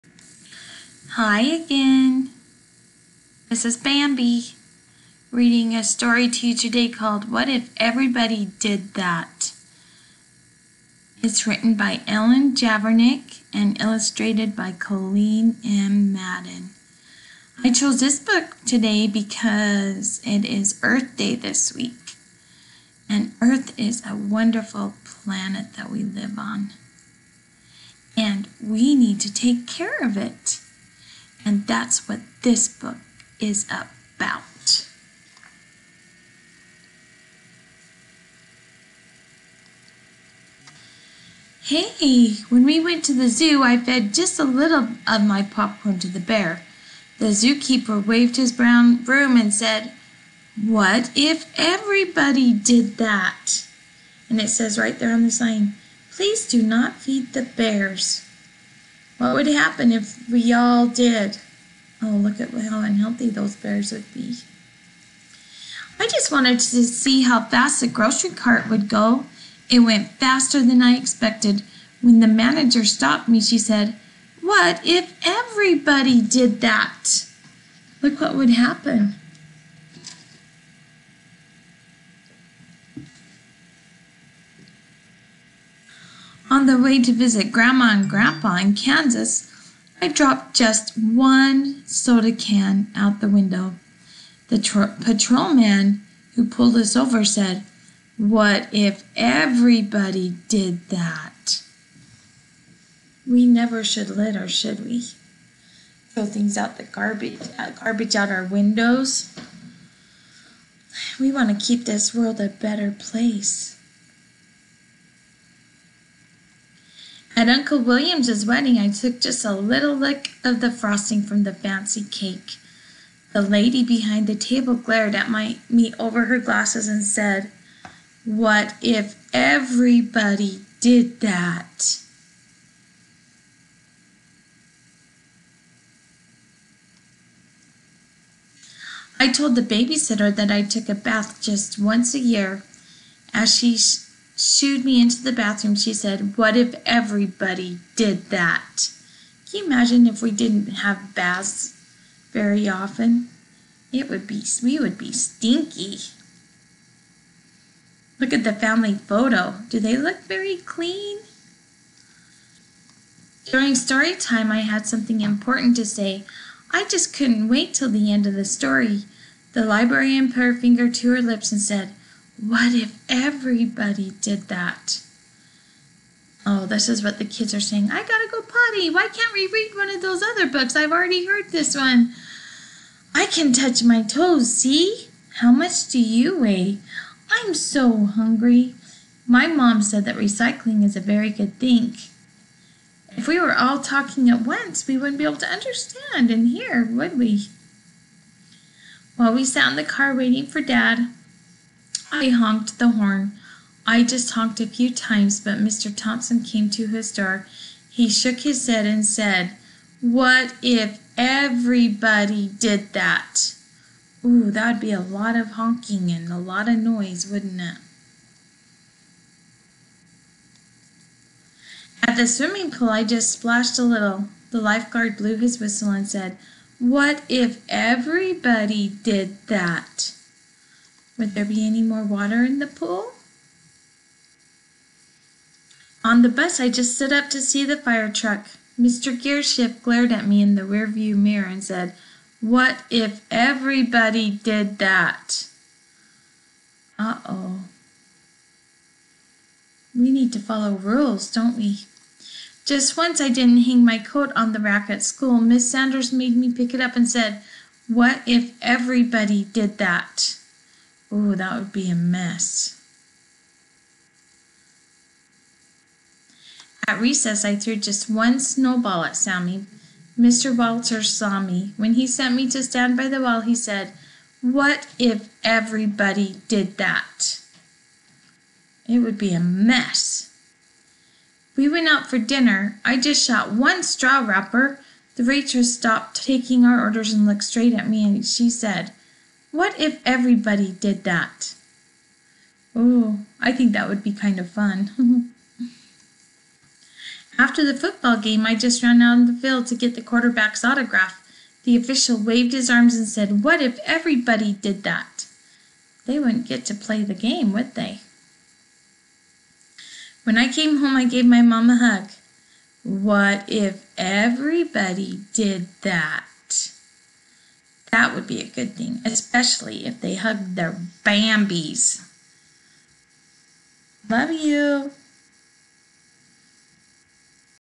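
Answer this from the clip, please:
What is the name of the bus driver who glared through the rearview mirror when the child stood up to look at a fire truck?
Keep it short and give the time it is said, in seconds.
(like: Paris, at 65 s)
Mr. Gearshift, at 238 s.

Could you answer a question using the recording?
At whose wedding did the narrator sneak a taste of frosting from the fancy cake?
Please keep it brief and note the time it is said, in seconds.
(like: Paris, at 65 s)
Uncle William, at 117 s.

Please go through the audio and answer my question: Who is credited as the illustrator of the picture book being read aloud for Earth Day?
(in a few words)
Colleen M. Madden.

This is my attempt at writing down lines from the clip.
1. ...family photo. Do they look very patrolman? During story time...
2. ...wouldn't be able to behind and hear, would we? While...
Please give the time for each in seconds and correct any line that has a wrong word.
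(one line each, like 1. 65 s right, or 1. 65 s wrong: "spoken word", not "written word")
1. 158 s wrong: "clean", not "patrolman"
2. 194 s wrong: "understand", not "behind".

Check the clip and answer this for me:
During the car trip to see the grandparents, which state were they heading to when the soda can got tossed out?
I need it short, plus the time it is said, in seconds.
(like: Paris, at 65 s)
Kansas, at 88 s.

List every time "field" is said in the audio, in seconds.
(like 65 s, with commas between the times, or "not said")
299 s.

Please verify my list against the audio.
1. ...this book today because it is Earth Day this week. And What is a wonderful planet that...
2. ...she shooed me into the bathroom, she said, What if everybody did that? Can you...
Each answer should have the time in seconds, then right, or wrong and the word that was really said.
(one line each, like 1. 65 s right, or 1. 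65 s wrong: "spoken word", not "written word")
1. 17 s wrong: "Earth", not "What"
2. 143 s right.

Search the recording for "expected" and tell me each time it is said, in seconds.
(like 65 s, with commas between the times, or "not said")
70 s.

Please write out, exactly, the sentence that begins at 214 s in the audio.
Ooh, that'd be a lot of honking and a lot of noise, wouldn't it?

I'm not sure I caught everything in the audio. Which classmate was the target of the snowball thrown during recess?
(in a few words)
Sammy.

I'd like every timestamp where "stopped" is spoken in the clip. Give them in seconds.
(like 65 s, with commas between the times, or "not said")
72 s, 285 s.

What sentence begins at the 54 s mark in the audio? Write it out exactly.
And it says right there on the sign, Please do not feed the bears.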